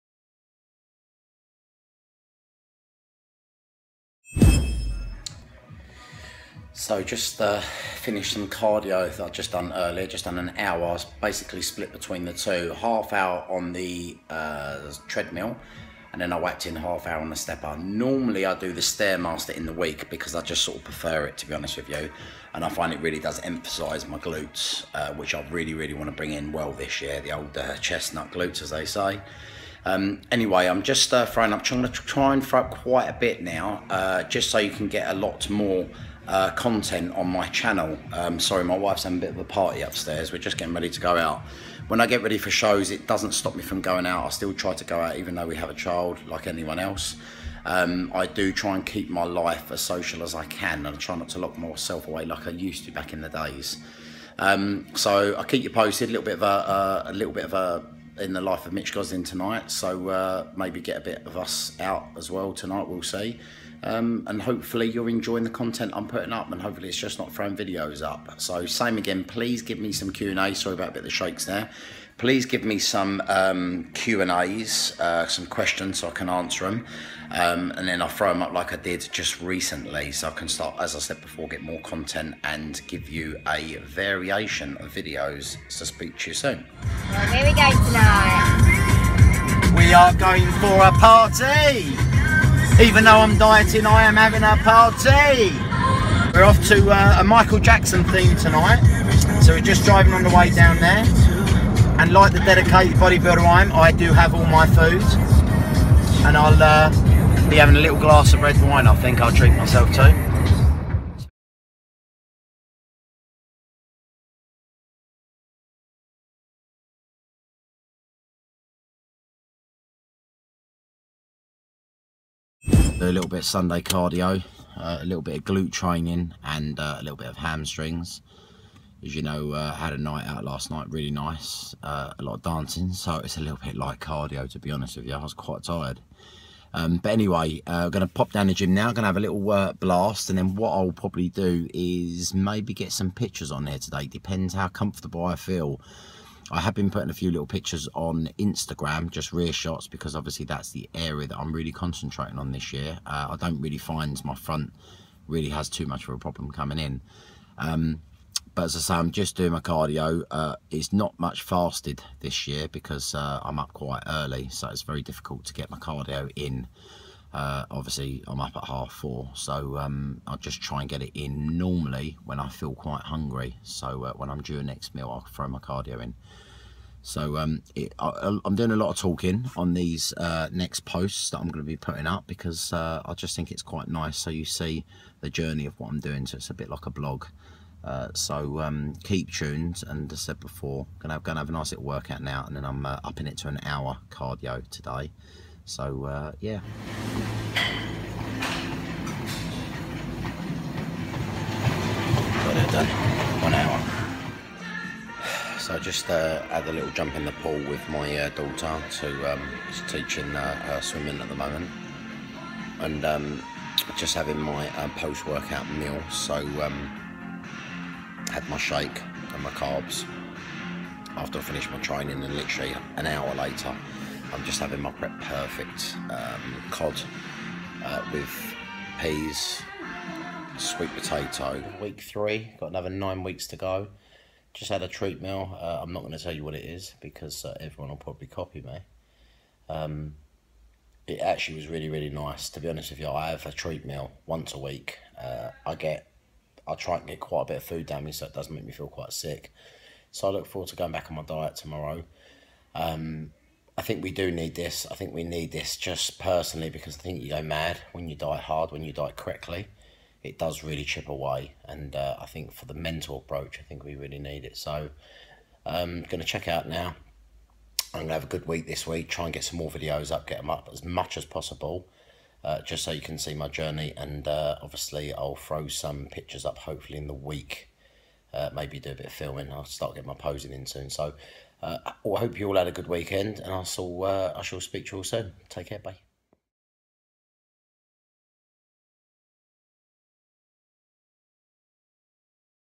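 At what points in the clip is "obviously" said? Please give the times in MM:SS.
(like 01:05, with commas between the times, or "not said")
02:30, 02:47, 04:34.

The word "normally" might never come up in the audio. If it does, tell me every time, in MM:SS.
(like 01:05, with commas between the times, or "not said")
00:17, 02:51.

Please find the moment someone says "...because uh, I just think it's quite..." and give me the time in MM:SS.
03:02.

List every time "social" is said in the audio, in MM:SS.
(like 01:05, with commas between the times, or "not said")
00:49.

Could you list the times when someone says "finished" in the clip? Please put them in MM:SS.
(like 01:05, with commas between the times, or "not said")
00:08, 03:41.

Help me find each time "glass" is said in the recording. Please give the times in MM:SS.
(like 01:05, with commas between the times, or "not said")
01:47.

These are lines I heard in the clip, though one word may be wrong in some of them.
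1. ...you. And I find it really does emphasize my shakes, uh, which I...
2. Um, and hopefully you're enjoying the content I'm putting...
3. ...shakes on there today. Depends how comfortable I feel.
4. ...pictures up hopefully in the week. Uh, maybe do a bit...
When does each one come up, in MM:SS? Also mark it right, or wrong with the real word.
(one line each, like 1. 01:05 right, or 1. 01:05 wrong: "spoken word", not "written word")
1. 00:21 wrong: "glutes", not "shakes"
2. 01:03 right
3. 02:23 wrong: "pictures", not "shakes"
4. 04:36 right.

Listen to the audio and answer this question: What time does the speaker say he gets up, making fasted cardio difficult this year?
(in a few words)
half four.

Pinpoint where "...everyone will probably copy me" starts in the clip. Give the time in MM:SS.
03:57.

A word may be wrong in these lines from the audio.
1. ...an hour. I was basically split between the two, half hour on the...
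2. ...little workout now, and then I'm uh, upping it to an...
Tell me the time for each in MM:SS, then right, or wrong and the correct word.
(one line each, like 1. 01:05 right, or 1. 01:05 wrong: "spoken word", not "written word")
1. 00:10 right
2. 03:11 right.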